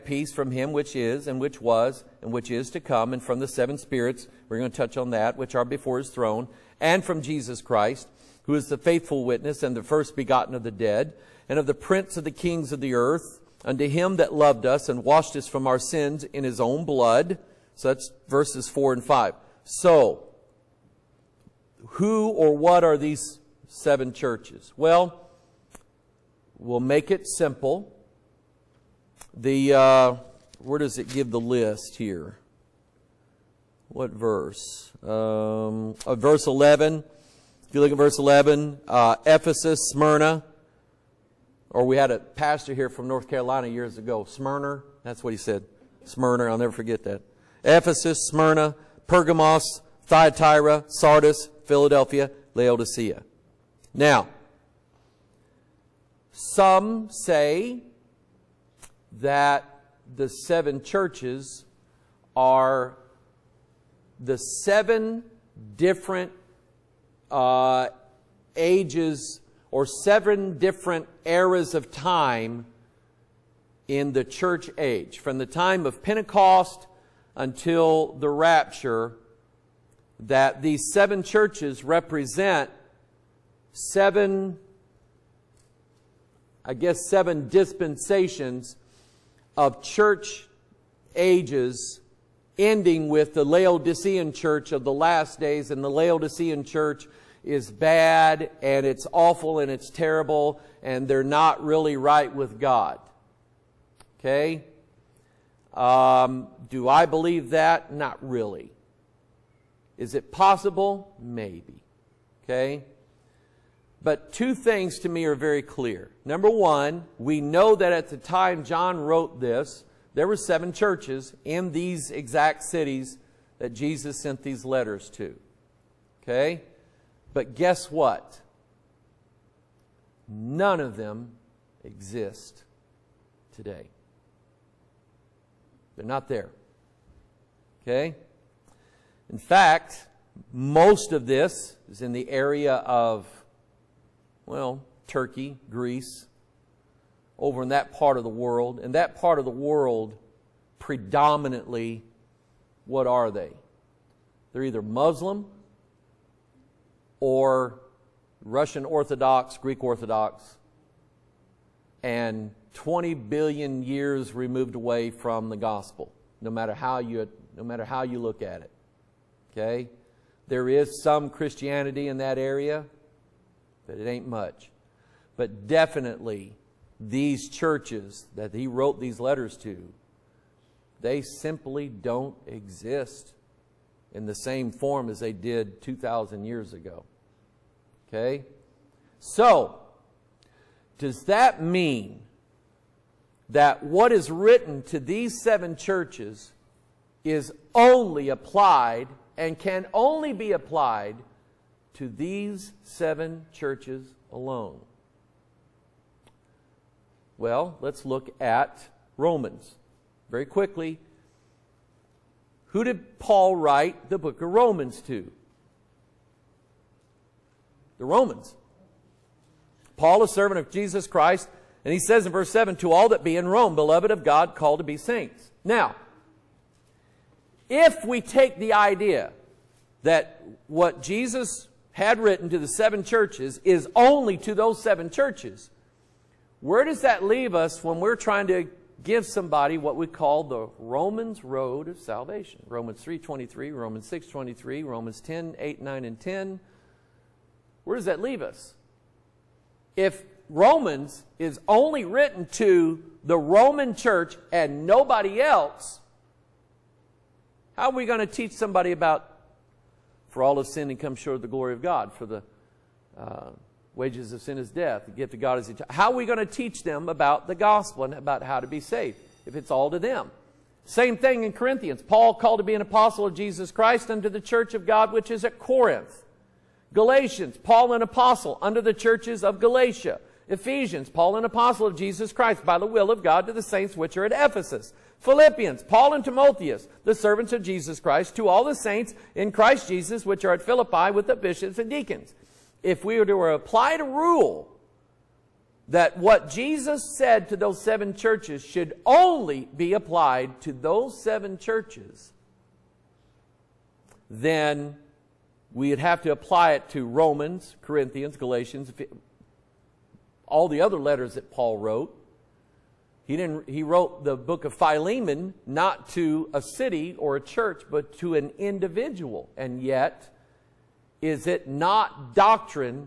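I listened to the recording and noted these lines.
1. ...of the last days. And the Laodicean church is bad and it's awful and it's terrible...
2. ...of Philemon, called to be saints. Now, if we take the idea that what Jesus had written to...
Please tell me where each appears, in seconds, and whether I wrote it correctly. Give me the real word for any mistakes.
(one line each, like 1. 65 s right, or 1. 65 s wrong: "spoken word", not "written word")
1. 94 s right
2. 224 s wrong: "God", not "Philemon".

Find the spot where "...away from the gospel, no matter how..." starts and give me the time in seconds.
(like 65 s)
164 s.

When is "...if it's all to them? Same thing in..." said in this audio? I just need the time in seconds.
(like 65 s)
269 s.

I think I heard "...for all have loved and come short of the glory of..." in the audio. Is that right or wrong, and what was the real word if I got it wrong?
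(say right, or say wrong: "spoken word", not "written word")
wrong: "sinned", not "loved".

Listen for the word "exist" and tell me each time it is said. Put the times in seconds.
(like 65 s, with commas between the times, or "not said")
131 s, 182 s.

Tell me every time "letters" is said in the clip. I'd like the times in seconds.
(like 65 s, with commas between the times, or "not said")
124 s, 179 s, 310 s.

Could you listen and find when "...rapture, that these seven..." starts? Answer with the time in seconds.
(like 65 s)
78 s.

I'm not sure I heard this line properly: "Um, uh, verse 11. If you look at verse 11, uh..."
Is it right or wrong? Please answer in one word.
right.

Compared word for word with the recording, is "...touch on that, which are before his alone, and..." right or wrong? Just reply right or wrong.
wrong.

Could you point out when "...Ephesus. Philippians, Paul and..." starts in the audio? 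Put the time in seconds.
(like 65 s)
284 s.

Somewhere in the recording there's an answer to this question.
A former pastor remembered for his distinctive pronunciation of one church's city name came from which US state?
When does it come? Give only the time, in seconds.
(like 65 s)
43 s.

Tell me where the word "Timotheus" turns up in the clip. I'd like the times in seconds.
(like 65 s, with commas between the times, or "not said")
286 s.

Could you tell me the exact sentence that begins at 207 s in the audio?
Well, let's look at Romans very quickly.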